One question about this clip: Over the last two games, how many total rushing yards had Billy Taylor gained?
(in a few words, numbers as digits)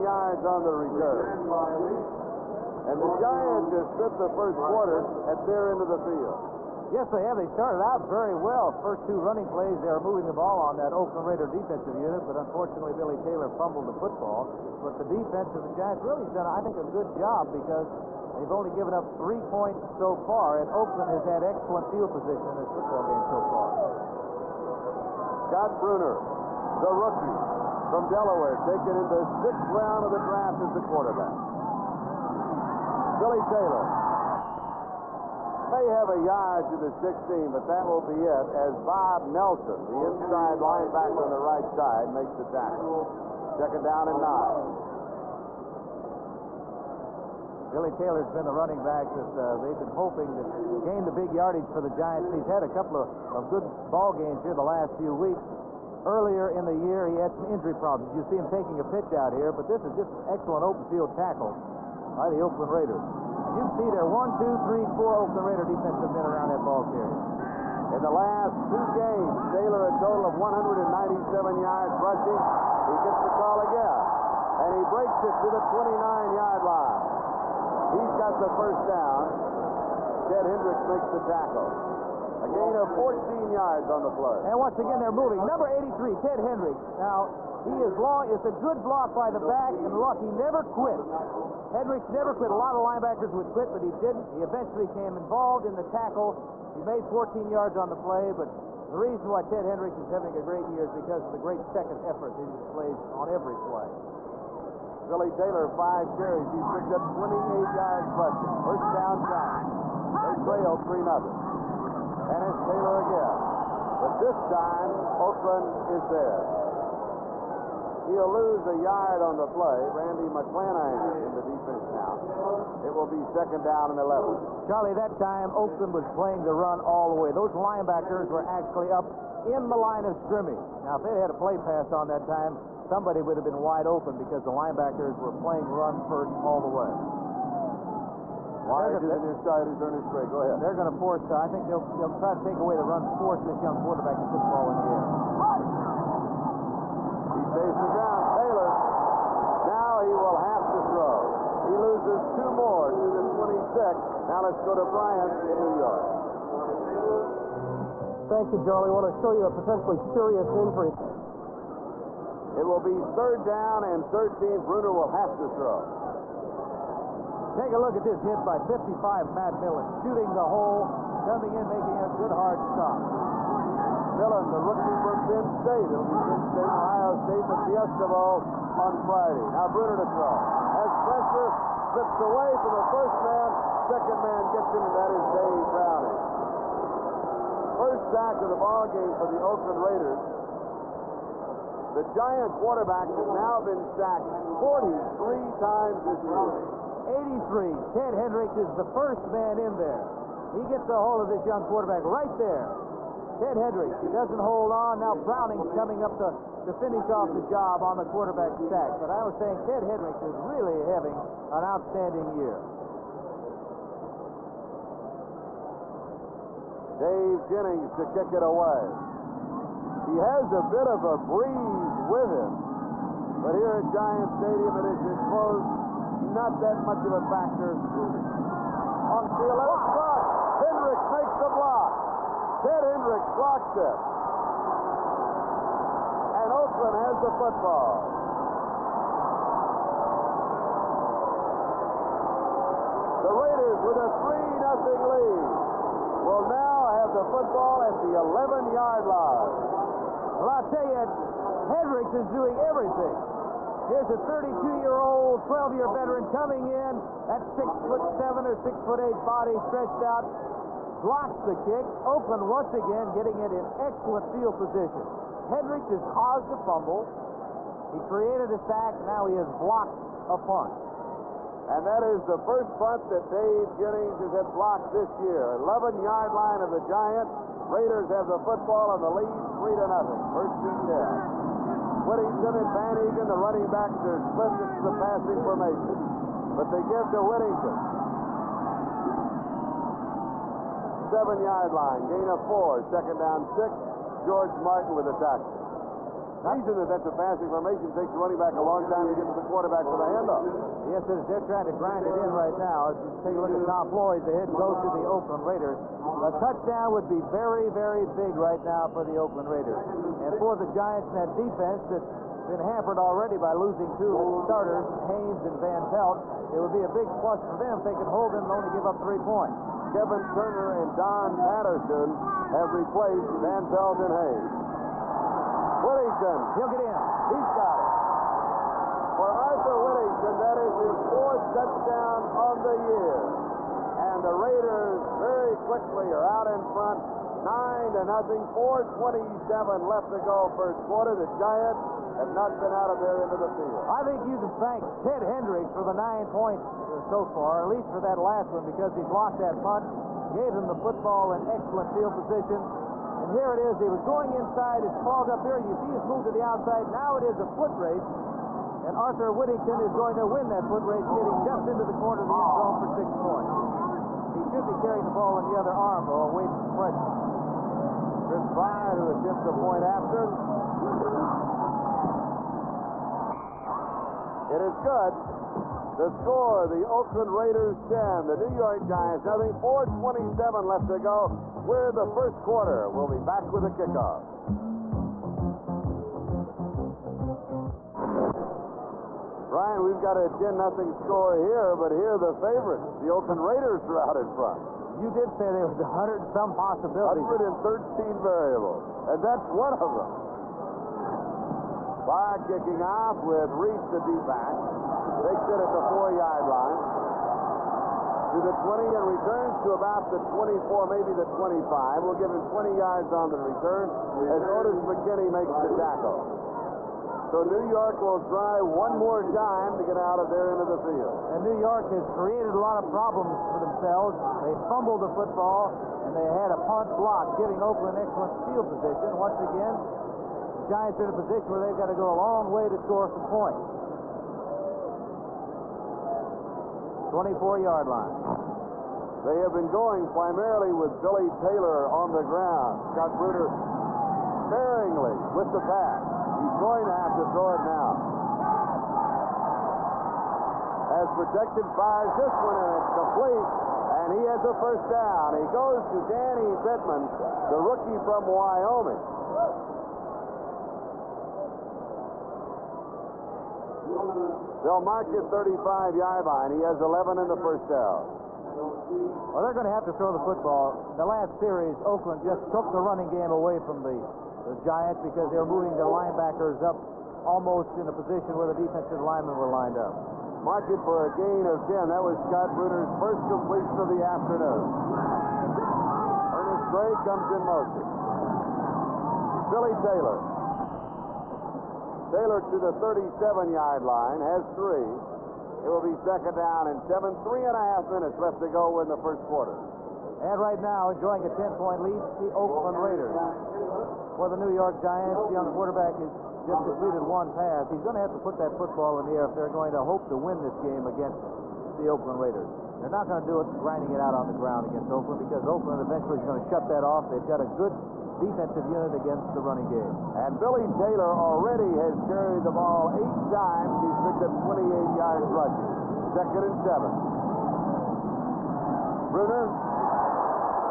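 197.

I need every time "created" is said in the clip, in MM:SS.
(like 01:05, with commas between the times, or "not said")
04:28, 07:02.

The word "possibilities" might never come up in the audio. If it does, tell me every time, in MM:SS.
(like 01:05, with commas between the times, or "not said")
06:36.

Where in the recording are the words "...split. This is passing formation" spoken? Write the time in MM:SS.
04:44.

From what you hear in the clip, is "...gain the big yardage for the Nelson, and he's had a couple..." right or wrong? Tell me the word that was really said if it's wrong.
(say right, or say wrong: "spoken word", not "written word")
wrong: "Giants", not "Nelson".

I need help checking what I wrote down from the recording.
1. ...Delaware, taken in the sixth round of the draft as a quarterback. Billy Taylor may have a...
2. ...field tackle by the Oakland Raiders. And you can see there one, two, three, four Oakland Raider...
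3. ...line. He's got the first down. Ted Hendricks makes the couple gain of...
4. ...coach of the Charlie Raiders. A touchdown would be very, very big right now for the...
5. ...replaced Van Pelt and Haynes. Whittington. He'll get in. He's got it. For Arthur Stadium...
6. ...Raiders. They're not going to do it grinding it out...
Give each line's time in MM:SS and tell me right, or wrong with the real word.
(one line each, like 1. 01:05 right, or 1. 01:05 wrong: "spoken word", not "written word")
1. 00:28 right
2. 01:00 right
3. 01:16 wrong: "tackle", not "couple"
4. 05:04 wrong: "Oakland", not "Charlie"
5. 05:22 wrong: "Whittington", not "Stadium"
6. 08:32 right.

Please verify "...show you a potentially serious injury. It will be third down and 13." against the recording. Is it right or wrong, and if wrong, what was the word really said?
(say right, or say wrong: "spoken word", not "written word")
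right.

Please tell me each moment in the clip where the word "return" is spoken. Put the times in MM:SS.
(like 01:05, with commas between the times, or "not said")
00:00, 06:49, 06:53.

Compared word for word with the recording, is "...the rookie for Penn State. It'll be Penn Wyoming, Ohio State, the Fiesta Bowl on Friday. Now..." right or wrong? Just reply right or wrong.
wrong.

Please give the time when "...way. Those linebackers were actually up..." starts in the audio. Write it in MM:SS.
02:07.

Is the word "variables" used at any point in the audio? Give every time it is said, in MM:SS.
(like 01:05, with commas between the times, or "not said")
06:38.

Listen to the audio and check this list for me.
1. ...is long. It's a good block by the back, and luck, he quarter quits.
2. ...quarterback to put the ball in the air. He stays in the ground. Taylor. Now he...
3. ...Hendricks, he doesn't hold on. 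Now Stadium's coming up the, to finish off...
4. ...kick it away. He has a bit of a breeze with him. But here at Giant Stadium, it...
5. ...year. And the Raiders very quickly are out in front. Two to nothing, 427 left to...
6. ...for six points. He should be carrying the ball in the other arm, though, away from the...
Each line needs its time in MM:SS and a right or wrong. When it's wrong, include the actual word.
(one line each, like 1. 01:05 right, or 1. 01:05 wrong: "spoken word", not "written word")
1. 01:27 wrong: "never", not "quarter"
2. 02:23 right
3. 03:23 wrong: "Browning", not "Stadium"
4. 03:38 right
5. 05:32 wrong: "Nine", not "Two"
6. 06:02 right.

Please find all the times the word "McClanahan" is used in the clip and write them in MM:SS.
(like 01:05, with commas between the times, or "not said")
02:00.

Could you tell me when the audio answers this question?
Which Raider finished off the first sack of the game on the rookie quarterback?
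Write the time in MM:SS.
03:05.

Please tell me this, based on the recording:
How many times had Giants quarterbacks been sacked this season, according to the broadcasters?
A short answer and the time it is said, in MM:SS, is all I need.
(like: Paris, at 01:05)
43, at 03:14.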